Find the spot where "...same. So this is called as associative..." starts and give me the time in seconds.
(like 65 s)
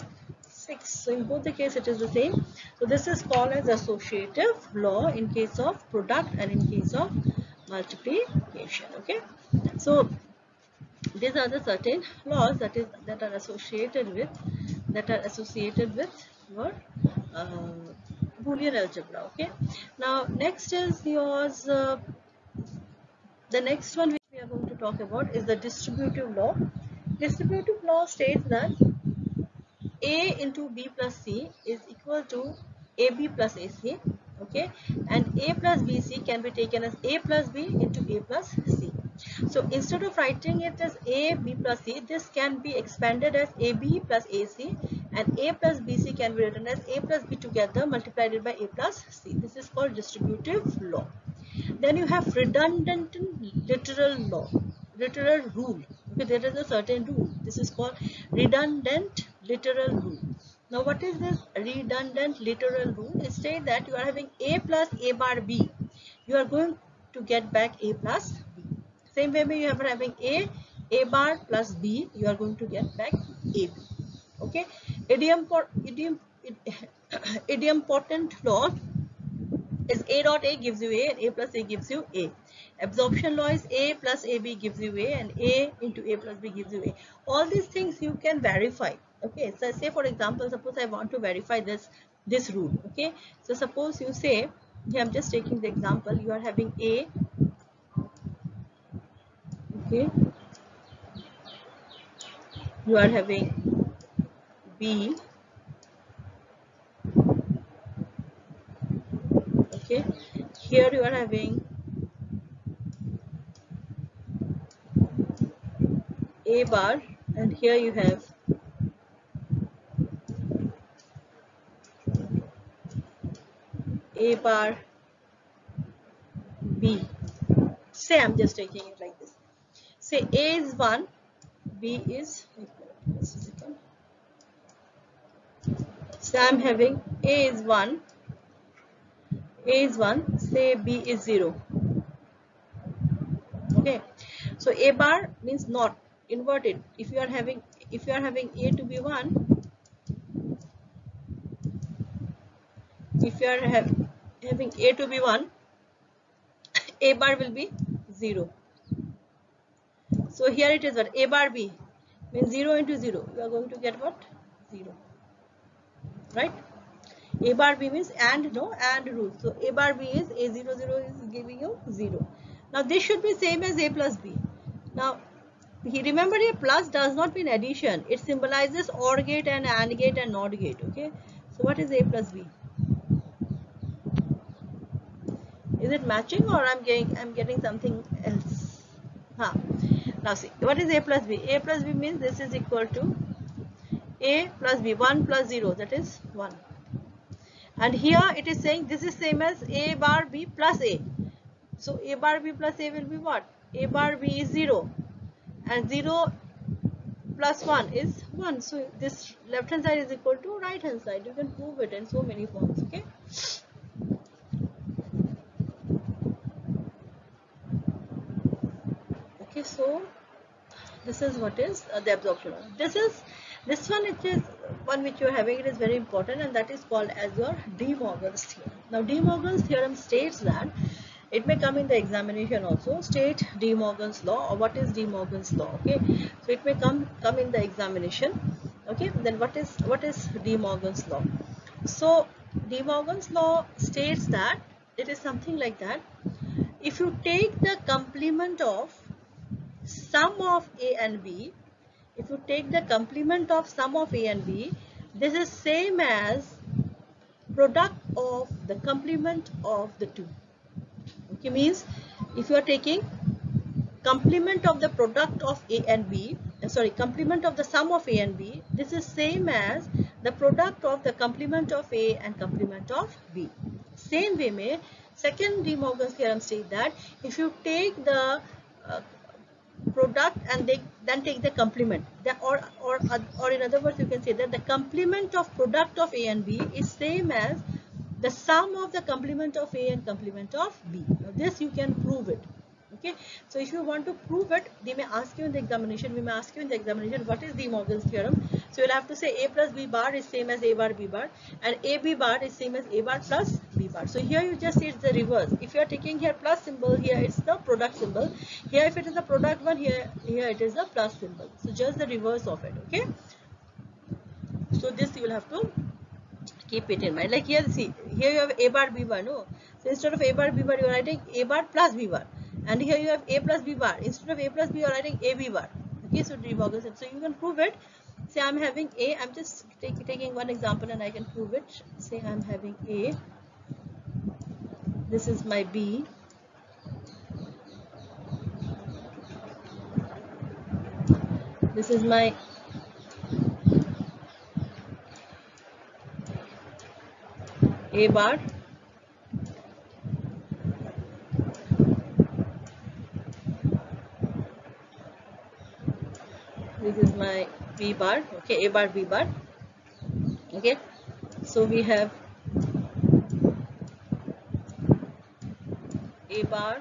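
2 s.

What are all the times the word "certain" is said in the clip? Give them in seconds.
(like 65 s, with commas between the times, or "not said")
11 s, 56 s.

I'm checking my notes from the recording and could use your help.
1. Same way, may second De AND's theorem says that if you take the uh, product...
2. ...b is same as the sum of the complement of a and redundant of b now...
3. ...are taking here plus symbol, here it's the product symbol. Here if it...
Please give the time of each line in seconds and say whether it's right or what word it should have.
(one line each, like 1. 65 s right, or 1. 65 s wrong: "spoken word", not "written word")
1. 273 s wrong: "Morgan", not "AND"
2. 286 s wrong: "complement", not "redundant"
3. 305 s right.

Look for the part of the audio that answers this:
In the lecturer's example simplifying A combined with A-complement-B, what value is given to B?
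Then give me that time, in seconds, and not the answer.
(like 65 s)
140 s.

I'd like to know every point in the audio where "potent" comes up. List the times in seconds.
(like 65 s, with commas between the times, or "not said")
75 s.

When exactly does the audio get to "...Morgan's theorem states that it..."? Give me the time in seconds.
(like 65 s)
229 s.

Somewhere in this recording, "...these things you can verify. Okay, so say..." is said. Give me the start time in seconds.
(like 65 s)
87 s.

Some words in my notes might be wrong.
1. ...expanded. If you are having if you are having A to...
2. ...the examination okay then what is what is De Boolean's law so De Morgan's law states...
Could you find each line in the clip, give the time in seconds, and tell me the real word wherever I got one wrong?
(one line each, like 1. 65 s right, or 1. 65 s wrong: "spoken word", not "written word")
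1. 146 s wrong: "inverted", not "expanded"
2. 237 s wrong: "Morgan", not "Boolean".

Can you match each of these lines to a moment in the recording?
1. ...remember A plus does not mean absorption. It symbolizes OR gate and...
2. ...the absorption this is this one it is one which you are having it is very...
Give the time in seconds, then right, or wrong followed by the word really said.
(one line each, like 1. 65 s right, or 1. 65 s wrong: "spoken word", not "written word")
1. 175 s wrong: "addition", not "absorption"
2. 221 s right.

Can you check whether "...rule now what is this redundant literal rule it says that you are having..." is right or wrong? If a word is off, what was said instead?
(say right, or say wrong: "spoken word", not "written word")
right.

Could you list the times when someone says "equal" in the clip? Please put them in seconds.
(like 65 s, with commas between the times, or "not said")
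31 s, 192 s, 210 s.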